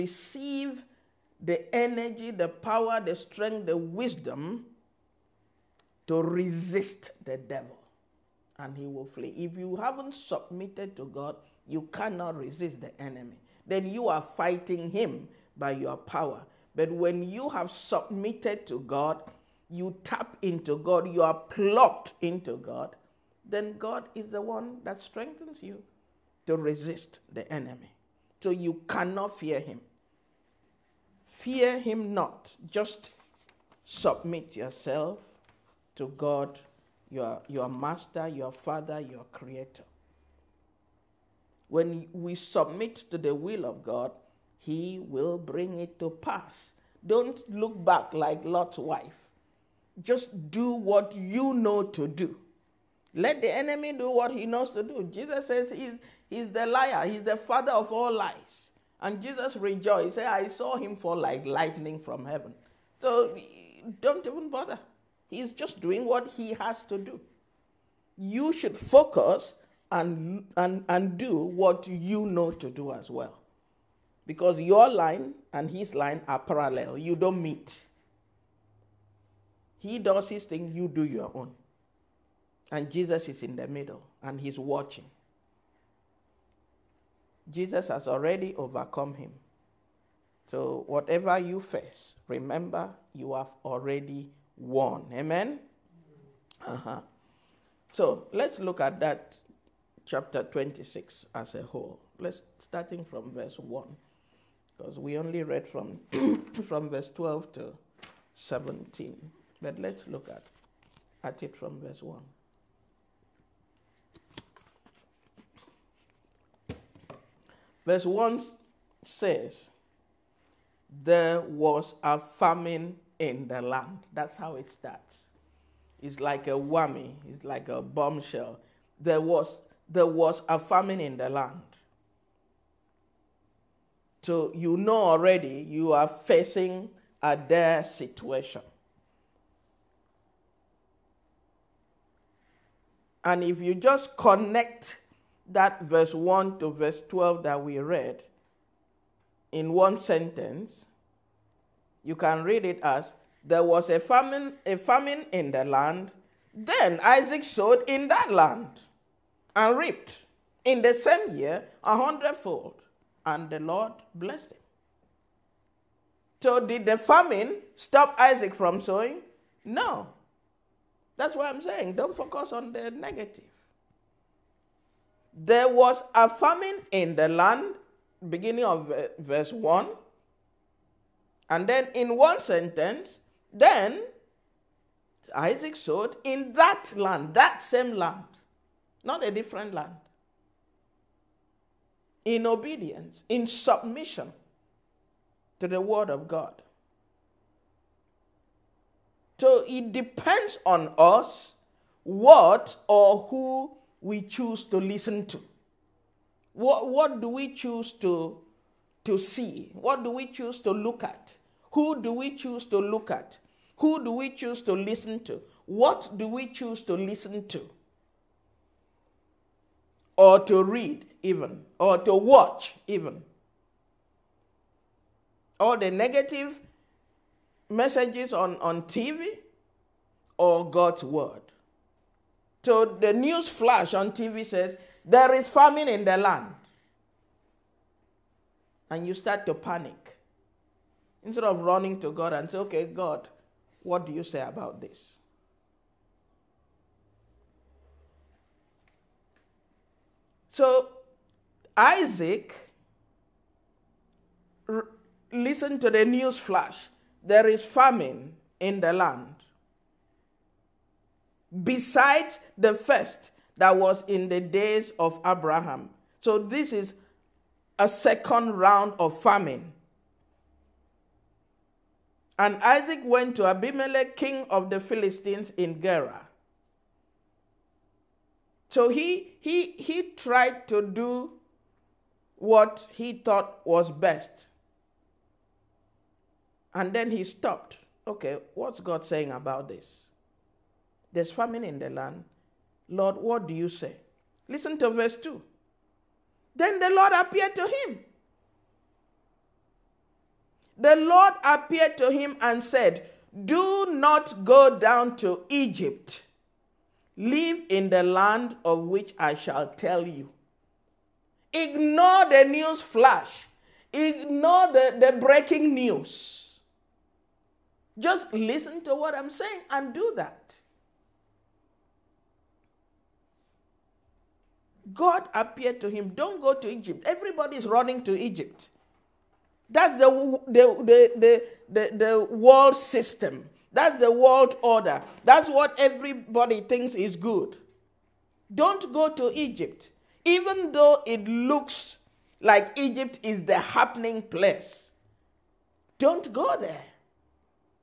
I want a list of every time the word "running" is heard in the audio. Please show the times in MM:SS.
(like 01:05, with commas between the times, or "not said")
04:01, 05:27.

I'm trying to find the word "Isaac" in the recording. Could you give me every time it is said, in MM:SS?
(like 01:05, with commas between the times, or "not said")
02:37, 02:48, 03:05, 04:11, 04:32.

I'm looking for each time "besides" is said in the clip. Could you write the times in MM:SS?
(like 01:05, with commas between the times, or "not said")
04:21.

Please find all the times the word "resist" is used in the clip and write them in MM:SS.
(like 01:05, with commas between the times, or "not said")
00:06, 00:12, 00:26.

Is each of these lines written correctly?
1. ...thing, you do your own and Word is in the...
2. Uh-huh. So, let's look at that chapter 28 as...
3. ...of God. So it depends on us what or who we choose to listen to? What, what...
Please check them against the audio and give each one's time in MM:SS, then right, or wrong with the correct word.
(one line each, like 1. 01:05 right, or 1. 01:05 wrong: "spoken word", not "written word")
1. 01:20 wrong: "Jesus", not "Word"
2. 01:36 wrong: "26", not "28"
3. 03:16 right.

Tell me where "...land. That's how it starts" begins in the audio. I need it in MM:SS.
02:03.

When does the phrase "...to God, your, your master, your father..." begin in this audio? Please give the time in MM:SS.
00:35.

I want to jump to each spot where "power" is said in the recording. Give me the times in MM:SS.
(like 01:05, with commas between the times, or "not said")
00:02, 00:15.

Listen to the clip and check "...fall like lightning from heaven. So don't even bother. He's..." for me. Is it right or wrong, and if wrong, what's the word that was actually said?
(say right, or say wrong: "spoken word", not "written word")
right.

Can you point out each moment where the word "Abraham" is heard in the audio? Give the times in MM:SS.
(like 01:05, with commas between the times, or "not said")
04:25.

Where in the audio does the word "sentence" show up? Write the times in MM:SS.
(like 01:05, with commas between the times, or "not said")
02:29, 03:02.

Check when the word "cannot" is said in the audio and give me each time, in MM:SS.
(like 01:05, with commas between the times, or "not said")
00:11, 00:28.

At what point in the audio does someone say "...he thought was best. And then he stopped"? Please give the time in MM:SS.
04:42.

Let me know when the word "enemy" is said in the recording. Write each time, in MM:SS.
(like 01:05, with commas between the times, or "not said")
00:13, 00:27, 00:53.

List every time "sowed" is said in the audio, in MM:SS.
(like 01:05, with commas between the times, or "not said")
02:37, 03:05.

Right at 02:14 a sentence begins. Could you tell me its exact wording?
So you know already you are facing a dire situation.